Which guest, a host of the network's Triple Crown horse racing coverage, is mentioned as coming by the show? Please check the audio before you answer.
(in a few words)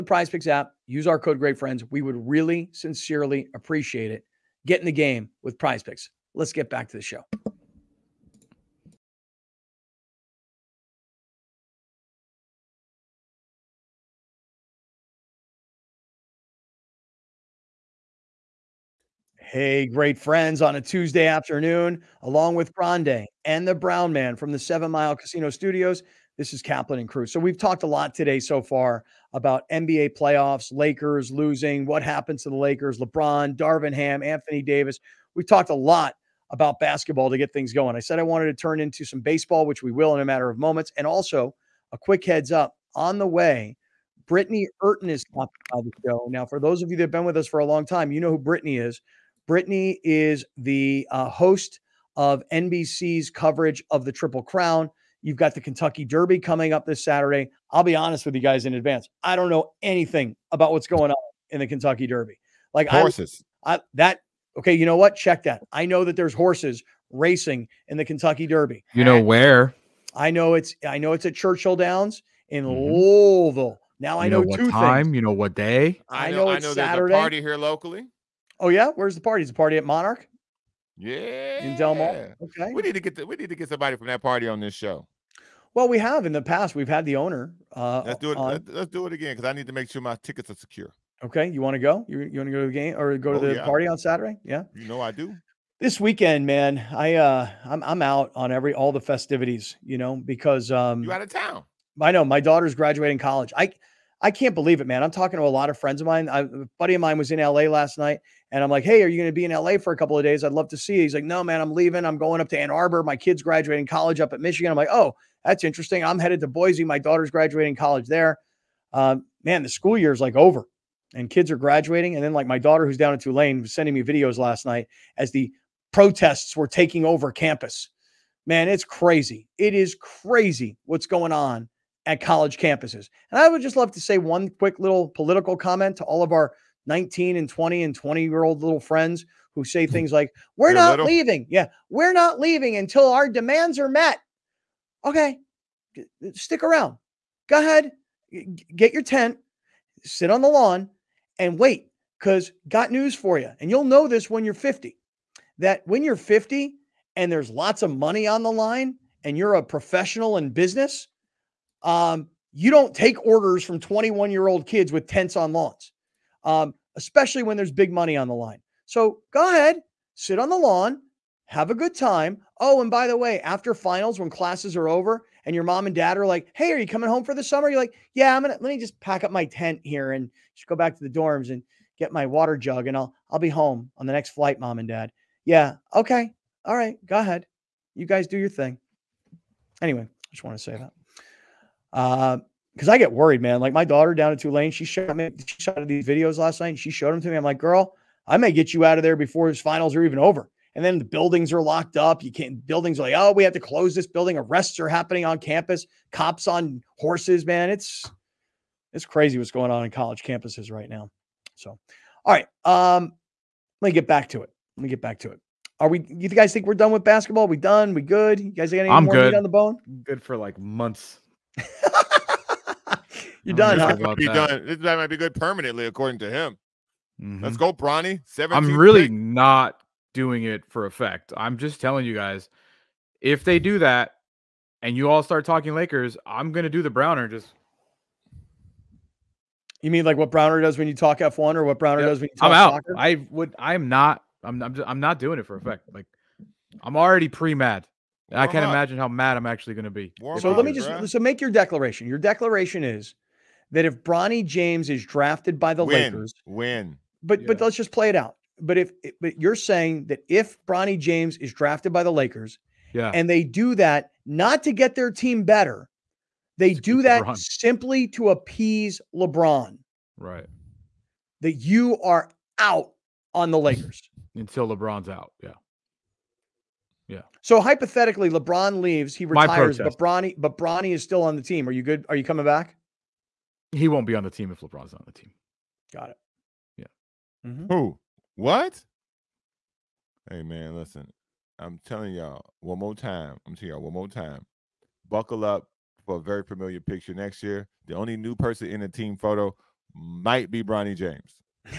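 Britney Eurton.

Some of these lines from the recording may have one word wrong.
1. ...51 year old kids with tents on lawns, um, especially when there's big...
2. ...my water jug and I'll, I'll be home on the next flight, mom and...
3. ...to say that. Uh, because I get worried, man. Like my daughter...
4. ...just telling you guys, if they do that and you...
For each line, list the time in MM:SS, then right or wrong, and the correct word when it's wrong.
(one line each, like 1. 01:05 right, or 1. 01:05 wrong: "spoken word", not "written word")
1. 02:43 wrong: "21", not "51"
2. 03:02 right
3. 03:10 right
4. 03:51 right.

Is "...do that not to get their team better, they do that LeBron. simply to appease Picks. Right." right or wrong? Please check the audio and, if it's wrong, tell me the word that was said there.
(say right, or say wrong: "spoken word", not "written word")
wrong: "LeBron", not "Picks".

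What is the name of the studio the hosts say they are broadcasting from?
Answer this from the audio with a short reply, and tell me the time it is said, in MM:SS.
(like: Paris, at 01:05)
Seven Mile Casino Studios, at 00:24.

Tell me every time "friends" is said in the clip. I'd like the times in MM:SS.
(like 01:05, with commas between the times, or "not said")
00:01, 00:20, 01:45, 02:18.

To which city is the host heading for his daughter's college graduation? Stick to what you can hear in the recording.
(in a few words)
Boise.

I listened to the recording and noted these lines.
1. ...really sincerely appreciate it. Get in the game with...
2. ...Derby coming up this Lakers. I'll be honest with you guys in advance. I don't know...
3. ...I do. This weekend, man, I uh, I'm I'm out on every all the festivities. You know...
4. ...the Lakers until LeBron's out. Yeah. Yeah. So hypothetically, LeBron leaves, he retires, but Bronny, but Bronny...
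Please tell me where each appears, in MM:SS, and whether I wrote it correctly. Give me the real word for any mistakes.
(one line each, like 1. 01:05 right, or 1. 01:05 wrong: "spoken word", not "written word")
1. 00:02 right
2. 00:56 wrong: "Saturday", not "Lakers"
3. 01:34 right
4. 04:33 right.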